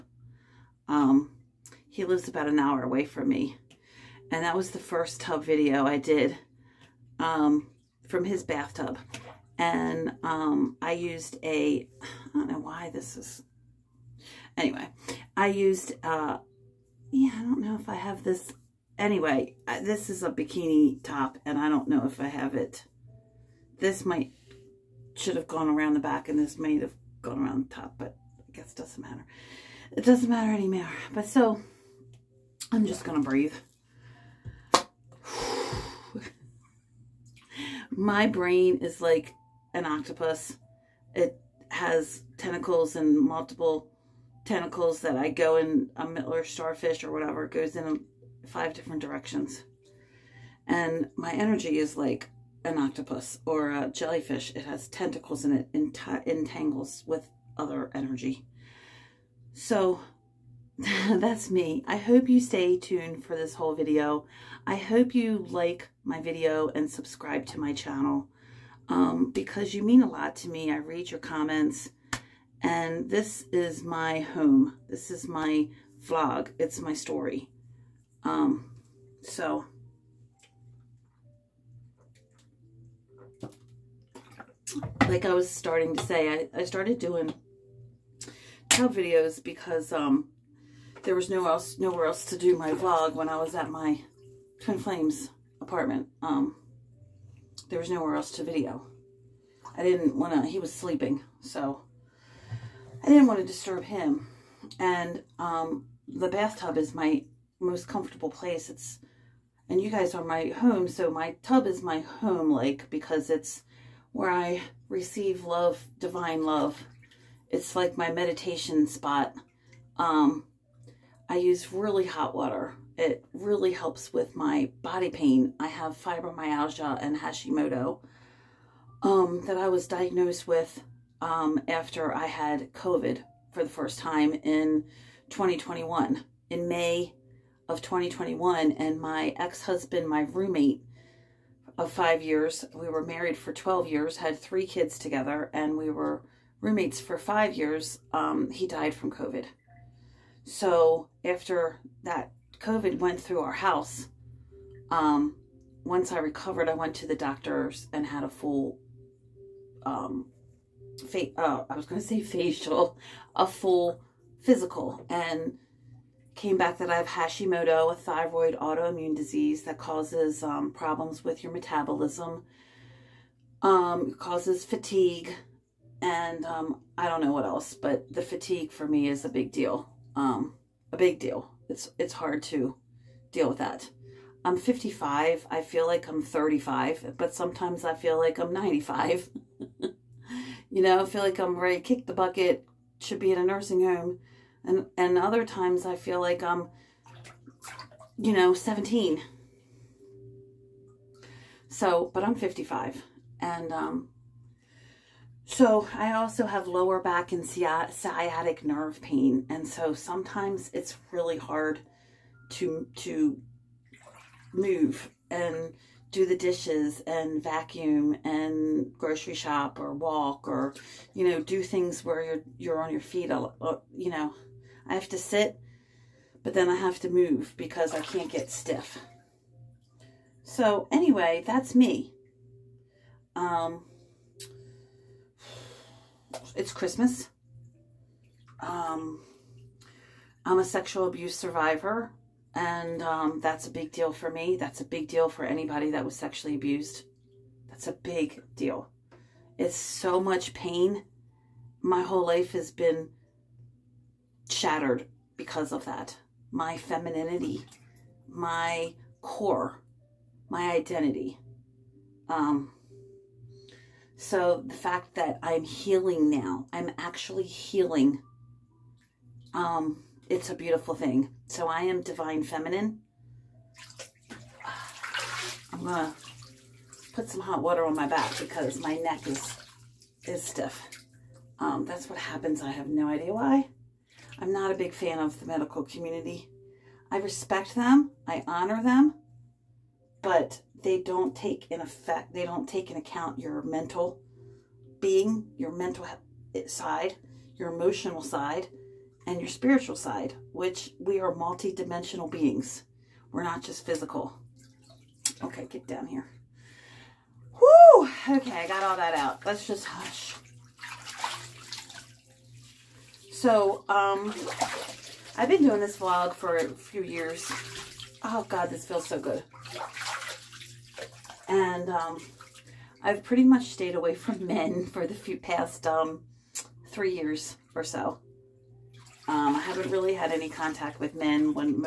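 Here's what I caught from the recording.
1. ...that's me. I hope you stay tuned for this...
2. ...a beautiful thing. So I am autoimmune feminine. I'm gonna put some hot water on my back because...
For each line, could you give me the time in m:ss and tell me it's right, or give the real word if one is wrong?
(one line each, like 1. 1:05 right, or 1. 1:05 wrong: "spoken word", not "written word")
1. 1:01 right
2. 4:30 wrong: "divine", not "autoimmune".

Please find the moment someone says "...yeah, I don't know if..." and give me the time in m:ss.
0:17.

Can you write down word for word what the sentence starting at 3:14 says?
And and other times I feel like I'm you know, 17.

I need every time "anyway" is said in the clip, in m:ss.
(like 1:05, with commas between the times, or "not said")
0:14, 0:18, 3:50.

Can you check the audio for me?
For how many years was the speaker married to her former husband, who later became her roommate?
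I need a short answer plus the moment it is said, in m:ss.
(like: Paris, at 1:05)
12, at 2:23.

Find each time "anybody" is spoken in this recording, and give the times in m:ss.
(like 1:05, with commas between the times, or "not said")
4:05.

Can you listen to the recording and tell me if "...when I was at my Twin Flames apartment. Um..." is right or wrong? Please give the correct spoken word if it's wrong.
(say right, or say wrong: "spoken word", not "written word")
right.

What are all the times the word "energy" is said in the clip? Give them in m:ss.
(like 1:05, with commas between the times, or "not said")
0:51, 0:57.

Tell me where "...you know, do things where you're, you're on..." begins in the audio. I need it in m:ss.
3:41.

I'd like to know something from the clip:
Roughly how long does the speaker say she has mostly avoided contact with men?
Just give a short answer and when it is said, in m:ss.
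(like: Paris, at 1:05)
3 years, at 5:26.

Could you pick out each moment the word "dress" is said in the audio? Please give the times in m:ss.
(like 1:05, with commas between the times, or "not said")
not said.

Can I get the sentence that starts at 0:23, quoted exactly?
This might, should have gone around the back and this might have gone around the top, but I guess it doesn't matter.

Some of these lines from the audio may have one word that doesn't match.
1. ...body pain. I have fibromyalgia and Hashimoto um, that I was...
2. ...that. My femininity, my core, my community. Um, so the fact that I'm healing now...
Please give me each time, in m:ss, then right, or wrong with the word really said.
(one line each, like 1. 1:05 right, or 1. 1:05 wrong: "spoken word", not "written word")
1. 2:04 right
2. 4:15 wrong: "identity", not "community".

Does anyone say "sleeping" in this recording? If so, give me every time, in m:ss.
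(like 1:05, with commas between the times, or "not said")
1:40.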